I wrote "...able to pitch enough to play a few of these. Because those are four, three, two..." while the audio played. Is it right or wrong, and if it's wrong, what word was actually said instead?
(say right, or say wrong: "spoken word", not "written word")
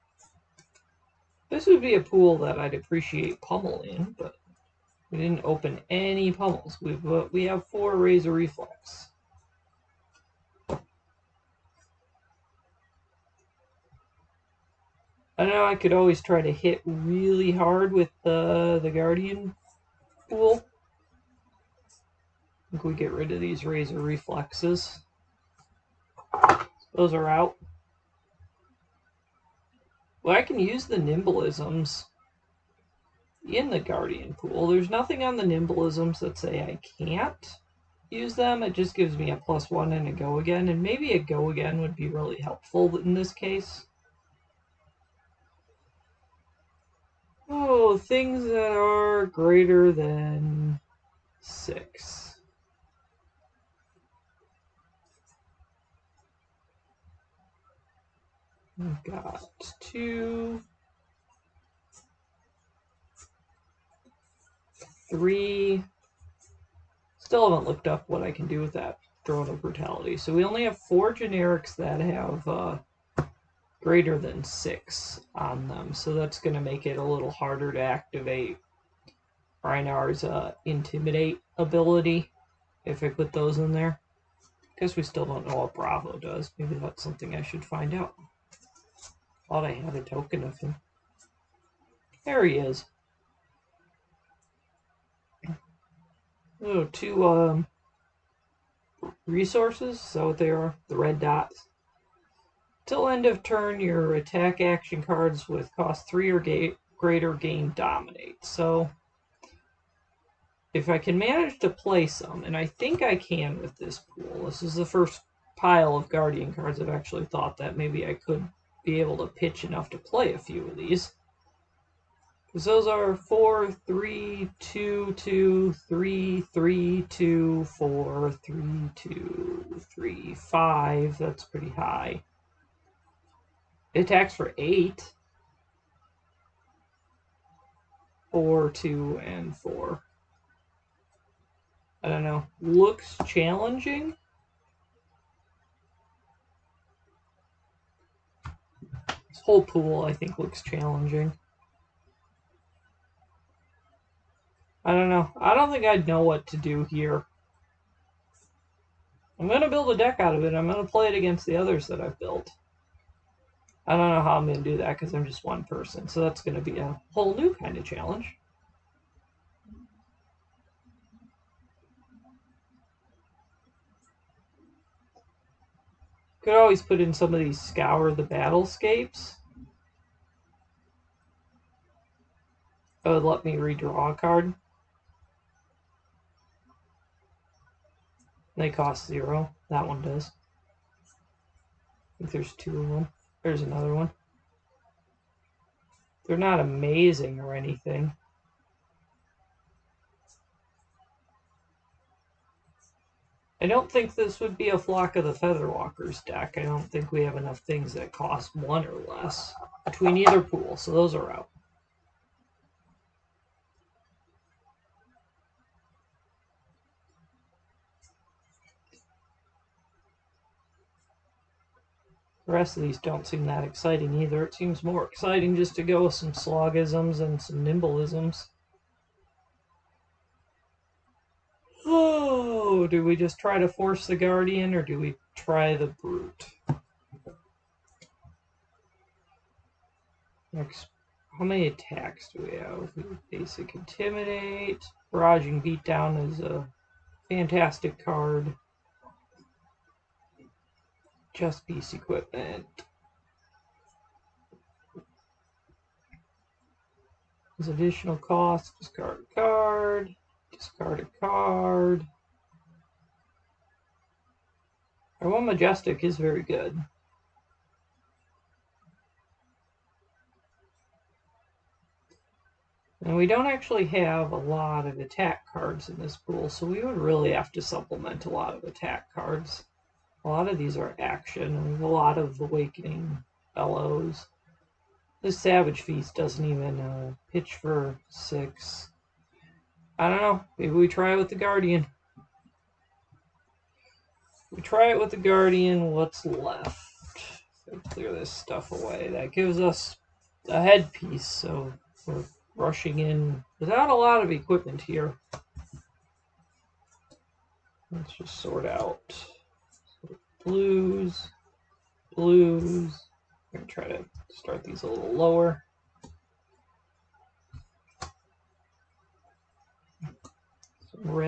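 right.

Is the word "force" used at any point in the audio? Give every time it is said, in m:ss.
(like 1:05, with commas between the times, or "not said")
3:53.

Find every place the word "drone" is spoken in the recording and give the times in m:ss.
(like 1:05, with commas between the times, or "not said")
1:09.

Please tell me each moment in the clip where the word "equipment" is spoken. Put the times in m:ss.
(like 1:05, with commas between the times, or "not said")
4:11, 5:04.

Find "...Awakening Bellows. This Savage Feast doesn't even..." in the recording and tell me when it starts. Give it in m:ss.
4:42.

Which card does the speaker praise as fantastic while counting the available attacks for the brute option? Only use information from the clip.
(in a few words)
Barraging Beatdown.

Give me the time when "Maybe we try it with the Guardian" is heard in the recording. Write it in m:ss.
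4:50.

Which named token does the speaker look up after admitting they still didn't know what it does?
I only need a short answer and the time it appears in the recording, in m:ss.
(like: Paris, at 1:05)
Bravo, at 1:25.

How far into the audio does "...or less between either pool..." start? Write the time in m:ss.
3:28.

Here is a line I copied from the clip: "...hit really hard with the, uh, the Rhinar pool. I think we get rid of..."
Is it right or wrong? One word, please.
wrong.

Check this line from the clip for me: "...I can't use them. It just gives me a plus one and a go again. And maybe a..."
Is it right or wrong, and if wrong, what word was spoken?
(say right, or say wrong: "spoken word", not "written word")
right.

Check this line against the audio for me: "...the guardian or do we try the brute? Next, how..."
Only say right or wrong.
right.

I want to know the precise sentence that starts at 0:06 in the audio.
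We've, we have four Razor Reflex.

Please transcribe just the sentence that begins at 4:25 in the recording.
Our one Majestic is very good.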